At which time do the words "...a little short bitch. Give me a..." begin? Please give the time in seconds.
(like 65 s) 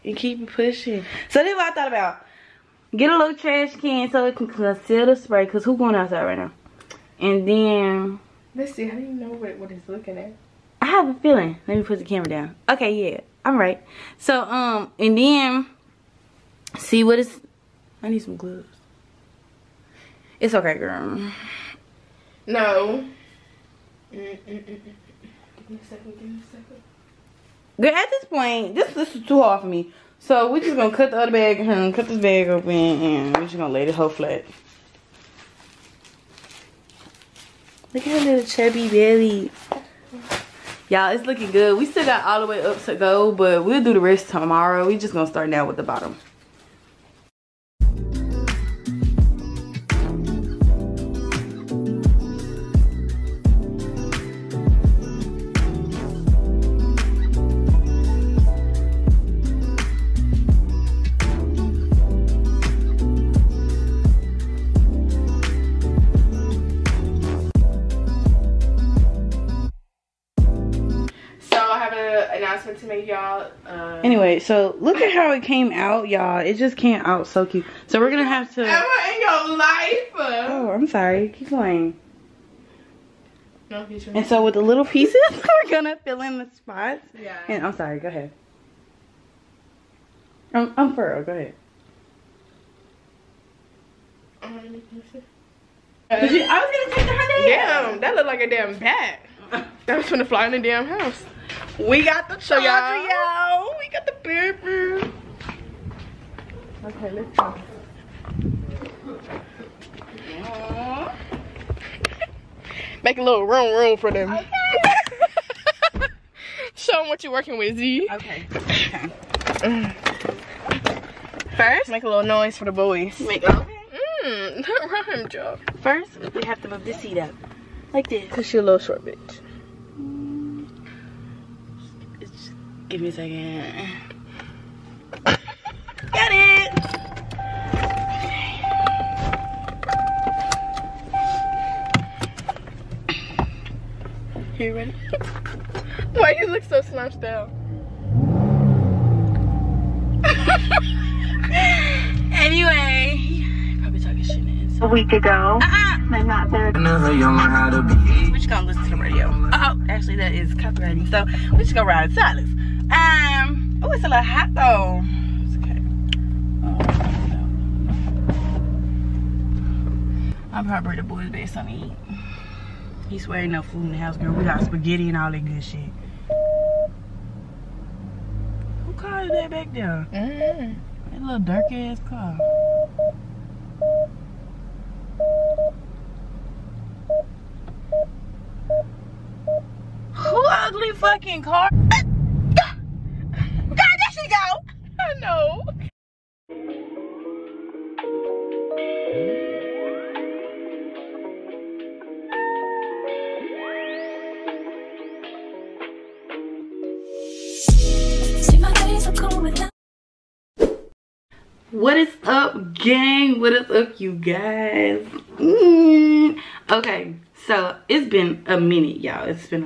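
128 s.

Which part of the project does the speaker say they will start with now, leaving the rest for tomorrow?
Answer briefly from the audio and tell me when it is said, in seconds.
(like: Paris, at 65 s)
the bottom, at 45 s.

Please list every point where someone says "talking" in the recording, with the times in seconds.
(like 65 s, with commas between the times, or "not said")
153 s.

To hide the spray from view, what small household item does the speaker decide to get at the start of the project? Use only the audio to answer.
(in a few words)
trash can.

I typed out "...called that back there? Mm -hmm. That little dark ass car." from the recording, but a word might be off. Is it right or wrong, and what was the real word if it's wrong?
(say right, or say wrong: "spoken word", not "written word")
right.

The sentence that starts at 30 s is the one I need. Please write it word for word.
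So we're just gonna cut the other bag and cut this bag open and we're just gonna lay the whole flat.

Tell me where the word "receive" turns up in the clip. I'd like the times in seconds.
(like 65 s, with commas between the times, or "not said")
not said.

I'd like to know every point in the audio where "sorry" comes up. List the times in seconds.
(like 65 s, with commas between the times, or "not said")
80 s, 87 s.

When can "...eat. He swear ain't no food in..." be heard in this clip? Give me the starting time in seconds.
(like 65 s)
171 s.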